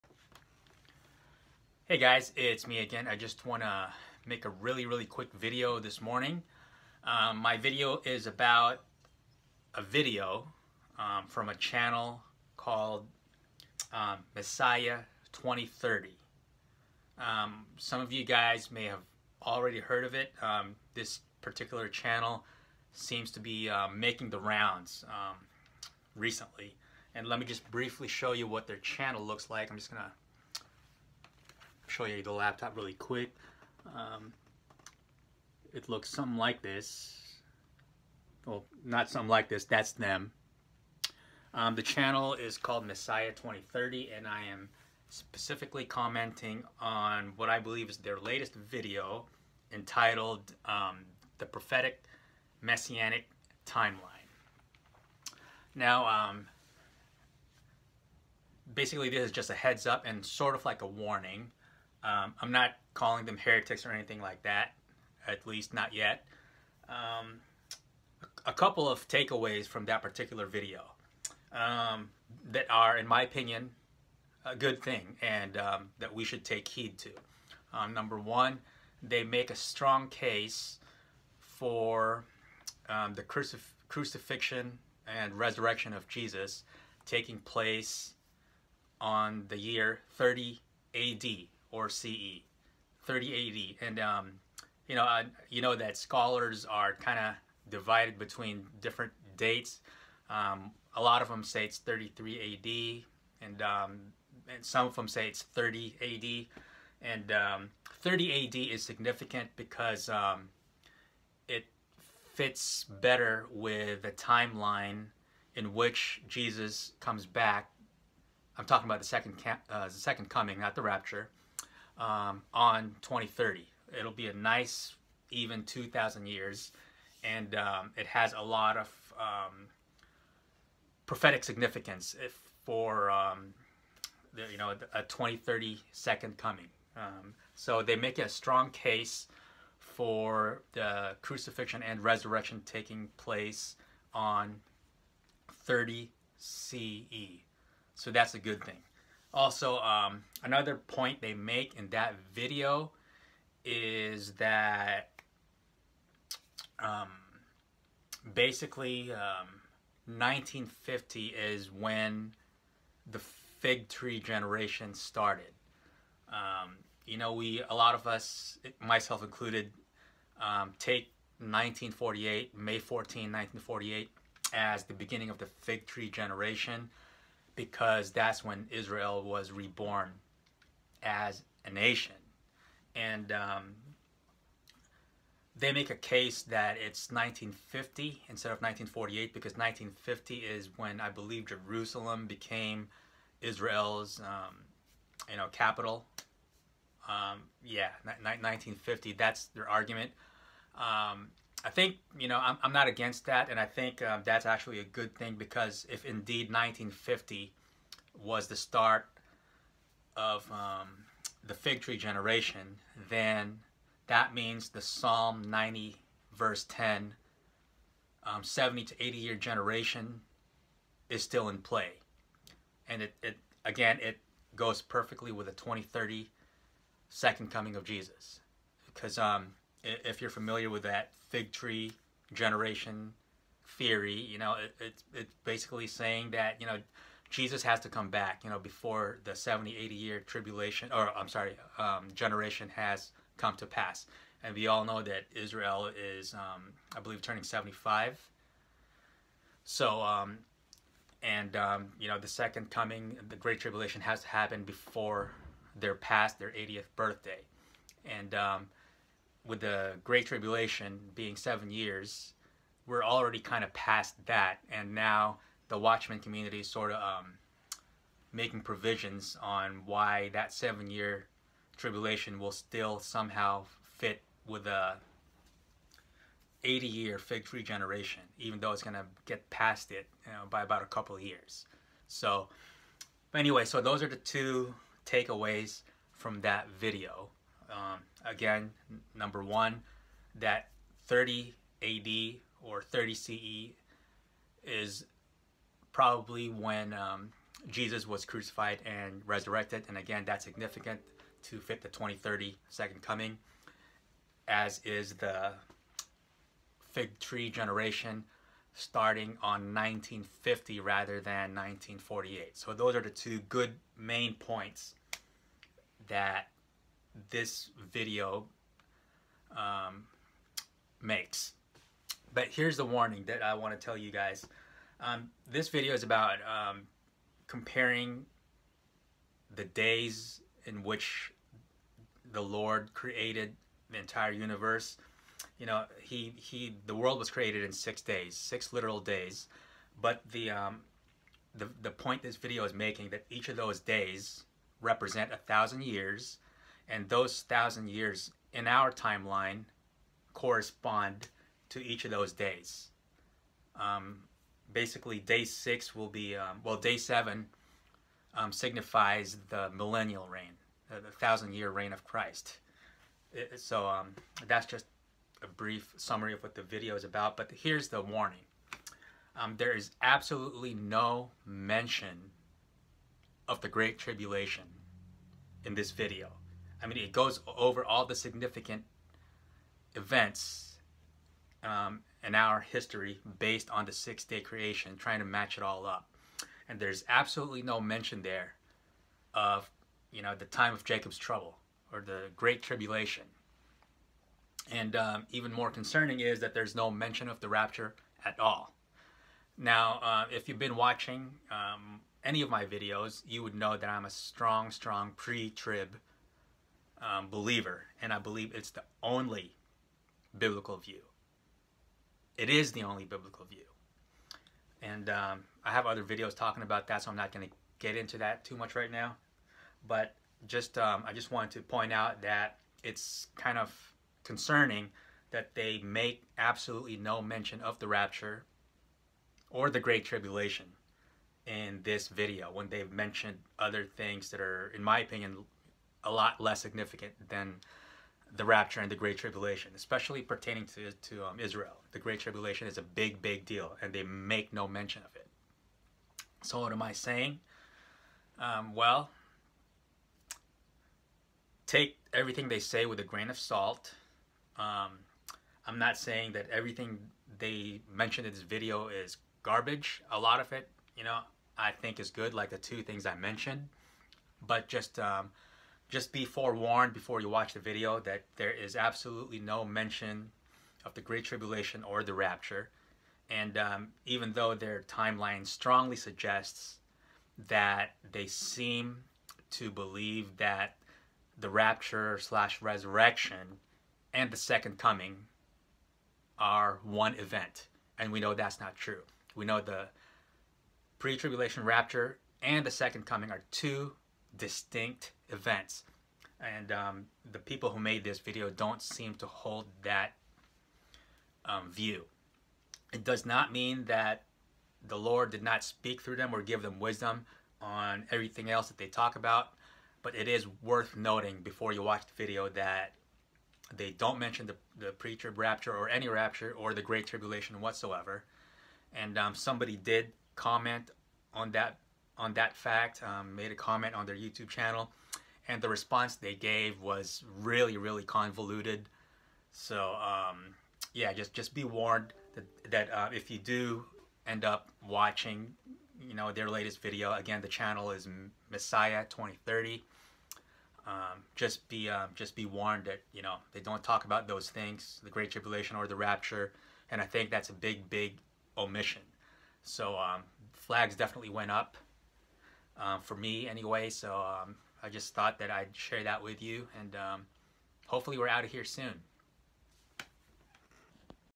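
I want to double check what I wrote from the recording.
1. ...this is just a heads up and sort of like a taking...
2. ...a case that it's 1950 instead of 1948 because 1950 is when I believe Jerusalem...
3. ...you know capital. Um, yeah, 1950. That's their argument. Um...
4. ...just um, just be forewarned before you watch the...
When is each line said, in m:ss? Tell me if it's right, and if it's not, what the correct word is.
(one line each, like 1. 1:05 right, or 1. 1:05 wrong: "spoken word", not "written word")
1. 0:59 wrong: "warning", not "taking"
2. 3:05 right
3. 3:15 right
4. 7:44 right.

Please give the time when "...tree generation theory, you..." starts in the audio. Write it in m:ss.
3:51.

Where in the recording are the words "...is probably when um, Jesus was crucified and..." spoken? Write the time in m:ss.
4:54.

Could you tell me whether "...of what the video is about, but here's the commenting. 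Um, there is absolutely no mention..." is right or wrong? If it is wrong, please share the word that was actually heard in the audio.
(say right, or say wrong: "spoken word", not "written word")
wrong: "warning", not "commenting".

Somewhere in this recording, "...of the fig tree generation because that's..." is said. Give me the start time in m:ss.
2:55.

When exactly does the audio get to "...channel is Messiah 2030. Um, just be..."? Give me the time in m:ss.
8:57.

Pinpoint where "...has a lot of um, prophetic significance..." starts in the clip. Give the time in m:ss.
2:08.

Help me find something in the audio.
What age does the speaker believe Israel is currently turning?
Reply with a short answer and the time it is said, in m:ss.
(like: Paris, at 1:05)
75, at 4:07.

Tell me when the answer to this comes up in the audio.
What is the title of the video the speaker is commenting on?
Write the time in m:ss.
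0:51.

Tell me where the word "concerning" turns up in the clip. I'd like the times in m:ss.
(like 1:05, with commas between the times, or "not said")
6:35, 7:04.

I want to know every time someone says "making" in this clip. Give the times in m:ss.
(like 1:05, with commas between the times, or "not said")
0:23, 4:28, 5:42.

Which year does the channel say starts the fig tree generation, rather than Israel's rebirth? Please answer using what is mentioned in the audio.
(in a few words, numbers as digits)
1950.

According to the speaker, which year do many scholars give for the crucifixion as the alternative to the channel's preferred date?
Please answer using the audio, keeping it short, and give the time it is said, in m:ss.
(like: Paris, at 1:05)
33 AD, at 1:41.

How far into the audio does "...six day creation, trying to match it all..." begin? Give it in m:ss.
6:23.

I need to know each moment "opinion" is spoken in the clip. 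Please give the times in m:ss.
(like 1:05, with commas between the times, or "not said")
1:13, 7:14.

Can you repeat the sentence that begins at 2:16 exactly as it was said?
Um, so they make a strong case for the crucifixion and resurrection taking place on 30 CE.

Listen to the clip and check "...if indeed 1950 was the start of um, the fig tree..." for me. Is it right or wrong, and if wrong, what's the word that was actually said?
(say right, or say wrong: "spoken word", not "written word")
right.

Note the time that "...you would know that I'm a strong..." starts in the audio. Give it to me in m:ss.
6:43.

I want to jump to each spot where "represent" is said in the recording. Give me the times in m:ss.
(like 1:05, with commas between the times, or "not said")
5:44.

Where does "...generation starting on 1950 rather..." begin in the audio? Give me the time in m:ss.
5:07.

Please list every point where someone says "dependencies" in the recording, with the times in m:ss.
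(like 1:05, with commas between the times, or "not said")
not said.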